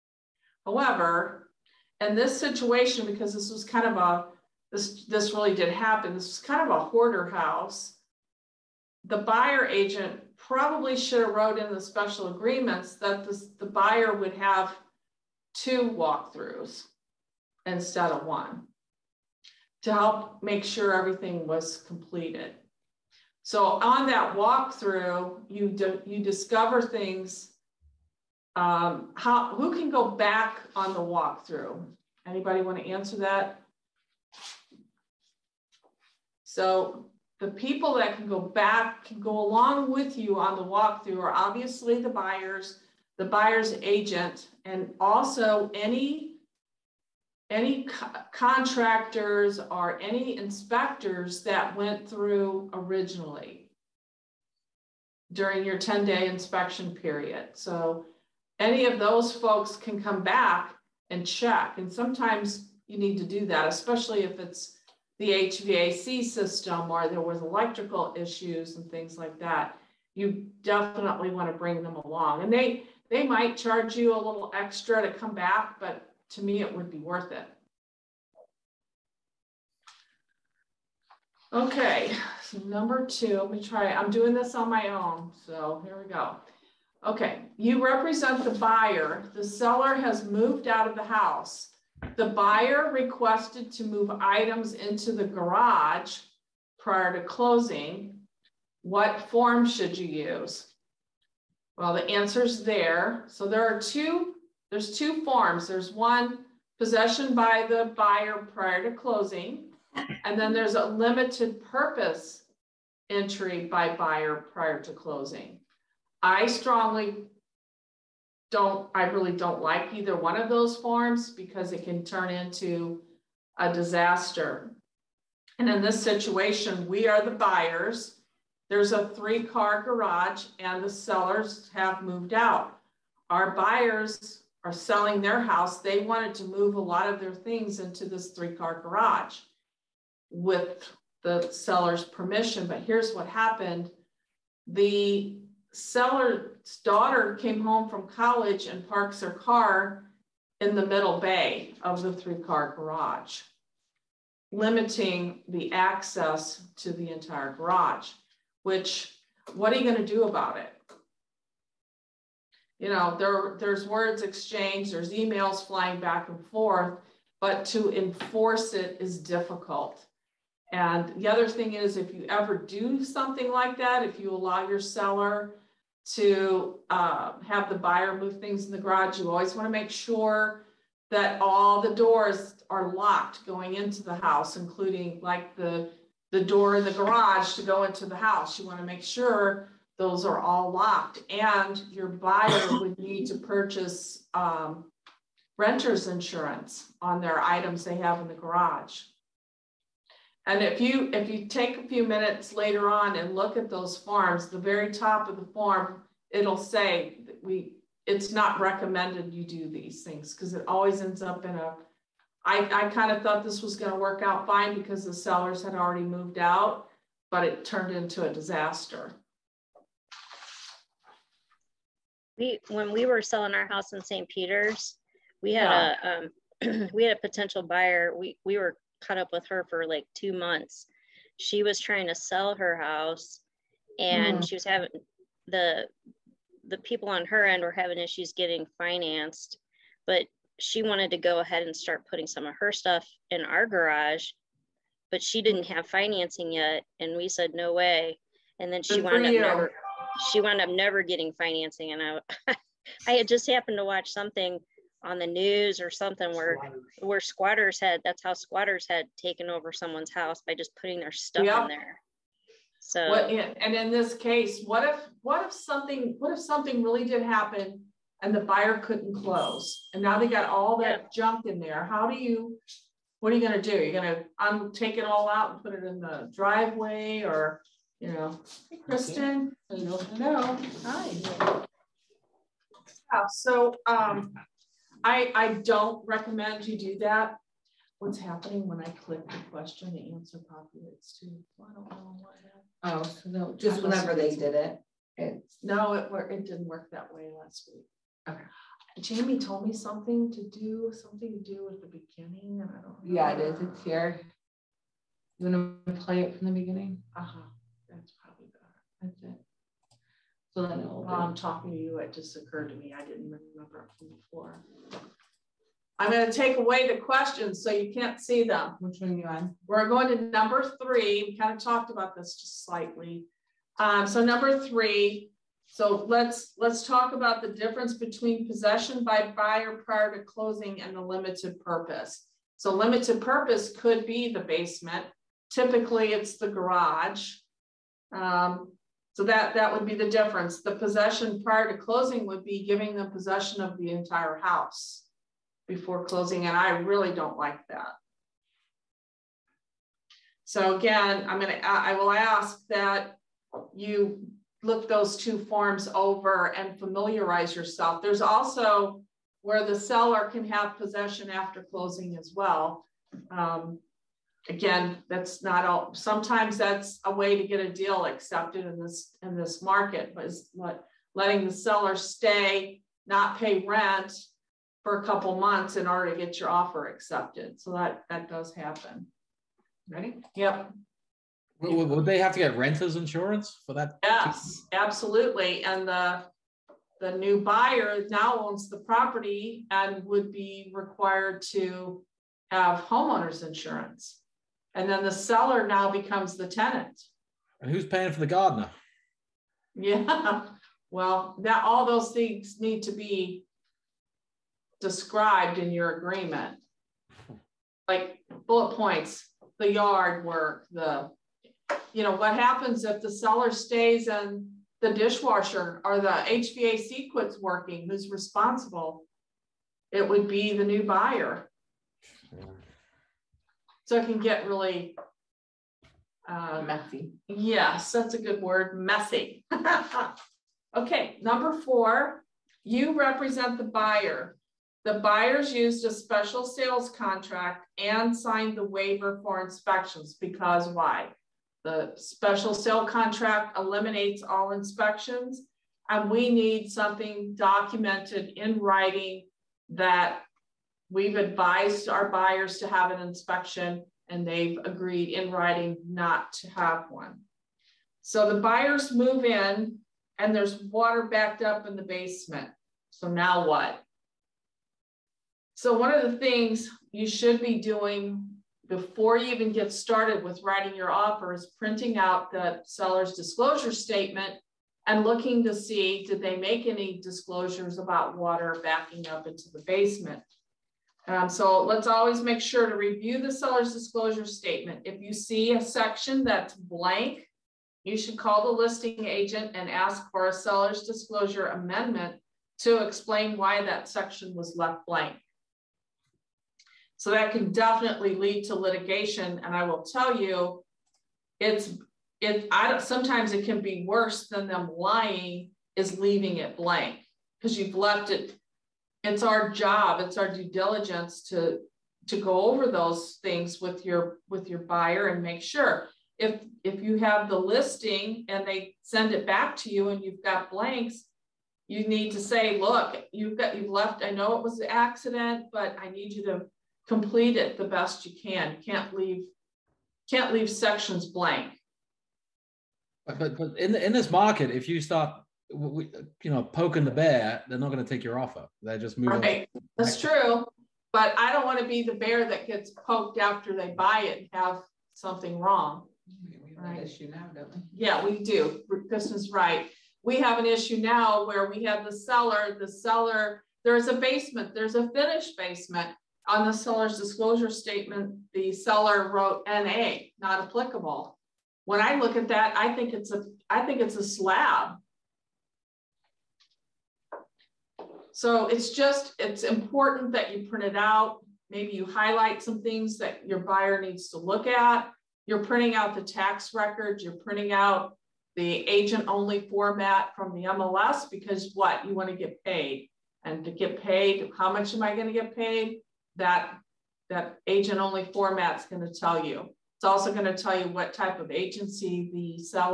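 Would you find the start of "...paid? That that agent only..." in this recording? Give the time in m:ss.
9:45.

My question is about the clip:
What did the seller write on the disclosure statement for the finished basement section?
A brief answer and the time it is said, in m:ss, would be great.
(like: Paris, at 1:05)
NA, at 9:19.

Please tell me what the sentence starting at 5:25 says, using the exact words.
So let's let's talk about the difference between possession by buyer prior to closing and the limited purpose.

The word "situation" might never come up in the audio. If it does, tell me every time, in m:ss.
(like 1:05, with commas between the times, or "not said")
0:02, 2:06.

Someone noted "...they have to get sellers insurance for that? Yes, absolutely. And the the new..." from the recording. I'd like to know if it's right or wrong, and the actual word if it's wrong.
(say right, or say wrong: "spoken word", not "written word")
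wrong: "renters", not "sellers".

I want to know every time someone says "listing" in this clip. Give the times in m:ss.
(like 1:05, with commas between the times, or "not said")
8:08, 8:37.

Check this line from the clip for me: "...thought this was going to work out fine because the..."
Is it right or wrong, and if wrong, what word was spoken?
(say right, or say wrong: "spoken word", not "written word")
right.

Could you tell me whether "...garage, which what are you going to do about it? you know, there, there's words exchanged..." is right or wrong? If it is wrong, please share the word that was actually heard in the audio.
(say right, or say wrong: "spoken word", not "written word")
right.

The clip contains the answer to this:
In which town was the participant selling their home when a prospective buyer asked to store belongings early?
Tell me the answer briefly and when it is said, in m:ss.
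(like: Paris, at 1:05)
St. Peter's, at 3:44.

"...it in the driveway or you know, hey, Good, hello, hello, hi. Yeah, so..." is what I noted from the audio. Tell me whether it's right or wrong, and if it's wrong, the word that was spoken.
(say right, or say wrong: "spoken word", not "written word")
wrong: "Kristen", not "Good".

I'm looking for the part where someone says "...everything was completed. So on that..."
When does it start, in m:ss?
0:20.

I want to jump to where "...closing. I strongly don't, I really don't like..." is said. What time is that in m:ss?
1:54.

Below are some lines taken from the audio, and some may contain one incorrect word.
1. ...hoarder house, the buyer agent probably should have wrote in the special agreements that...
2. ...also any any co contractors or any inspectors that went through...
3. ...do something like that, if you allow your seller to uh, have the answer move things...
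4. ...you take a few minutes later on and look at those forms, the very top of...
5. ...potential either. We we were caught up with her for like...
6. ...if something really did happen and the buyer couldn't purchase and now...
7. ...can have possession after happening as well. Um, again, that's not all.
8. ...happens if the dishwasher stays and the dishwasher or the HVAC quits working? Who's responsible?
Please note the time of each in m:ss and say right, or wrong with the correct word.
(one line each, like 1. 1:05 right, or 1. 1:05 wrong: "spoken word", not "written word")
1. 0:06 right
2. 0:44 right
3. 2:52 wrong: "buyer", not "answer"
4. 3:21 right
5. 3:47 wrong: "buyer", not "either"
6. 4:26 wrong: "close", not "purchase"
7. 6:00 wrong: "closing", not "happening"
8. 6:52 wrong: "seller", not "dishwasher".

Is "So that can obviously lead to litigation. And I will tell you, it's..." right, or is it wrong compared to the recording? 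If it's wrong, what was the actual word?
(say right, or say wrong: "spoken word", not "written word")
wrong: "definitely", not "obviously".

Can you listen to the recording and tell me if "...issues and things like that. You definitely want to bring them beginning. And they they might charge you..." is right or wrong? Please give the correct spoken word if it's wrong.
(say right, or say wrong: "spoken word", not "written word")
wrong: "along", not "beginning".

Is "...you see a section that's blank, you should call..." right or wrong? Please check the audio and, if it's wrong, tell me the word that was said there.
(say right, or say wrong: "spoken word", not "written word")
right.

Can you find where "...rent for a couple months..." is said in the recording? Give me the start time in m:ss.
6:13.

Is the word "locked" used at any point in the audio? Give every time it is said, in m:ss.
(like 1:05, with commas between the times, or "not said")
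3:02, 3:10.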